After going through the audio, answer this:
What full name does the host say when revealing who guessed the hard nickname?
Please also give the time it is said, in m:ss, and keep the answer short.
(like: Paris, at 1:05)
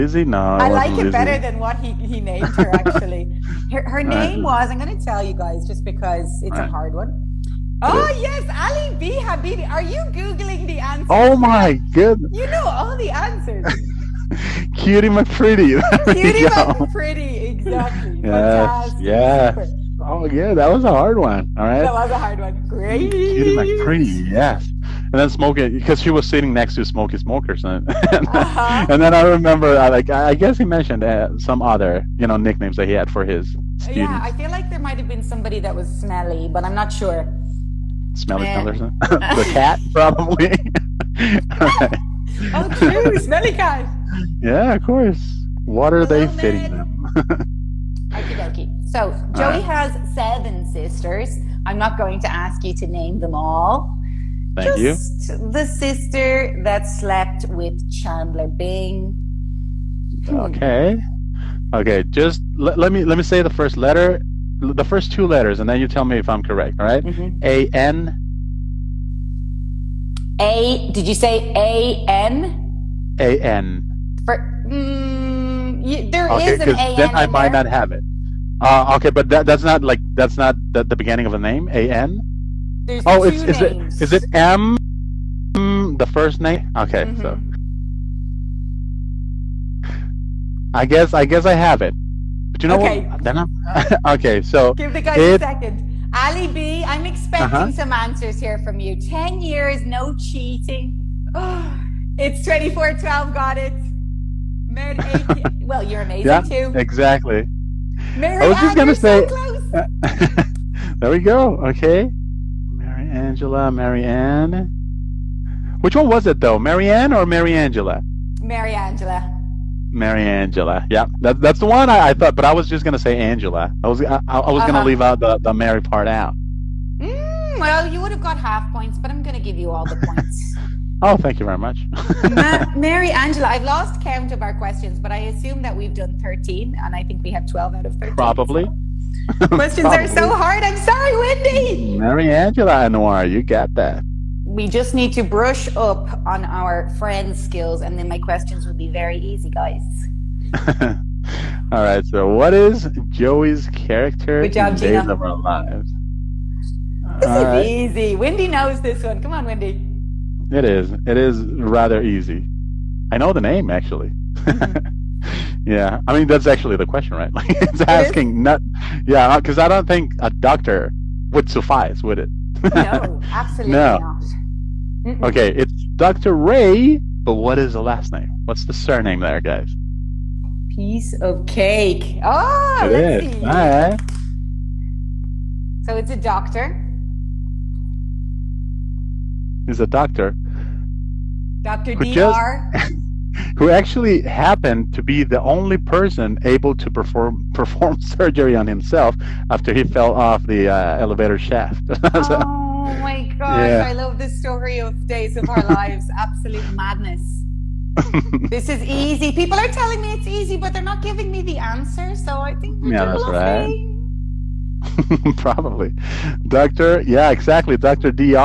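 Ali B Habibi, at 0:08.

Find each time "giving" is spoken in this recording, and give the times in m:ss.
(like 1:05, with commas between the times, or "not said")
3:31.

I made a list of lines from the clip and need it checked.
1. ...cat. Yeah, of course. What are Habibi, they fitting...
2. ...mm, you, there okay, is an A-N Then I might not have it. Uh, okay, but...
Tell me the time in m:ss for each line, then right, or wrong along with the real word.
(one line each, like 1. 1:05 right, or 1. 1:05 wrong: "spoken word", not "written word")
1. 0:43 wrong: "Hello", not "Habibi"
2. 1:14 right.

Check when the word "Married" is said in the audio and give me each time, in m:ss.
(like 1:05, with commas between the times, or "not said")
1:44.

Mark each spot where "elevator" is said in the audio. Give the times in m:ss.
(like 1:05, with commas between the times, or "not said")
3:20.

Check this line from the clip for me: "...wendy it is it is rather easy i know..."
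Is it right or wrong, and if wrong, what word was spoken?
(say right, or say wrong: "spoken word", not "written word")
right.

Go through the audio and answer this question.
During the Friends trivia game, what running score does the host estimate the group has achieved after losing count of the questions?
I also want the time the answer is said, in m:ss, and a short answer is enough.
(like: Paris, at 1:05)
12 out of 13, at 2:17.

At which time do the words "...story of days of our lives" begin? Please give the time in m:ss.
3:24.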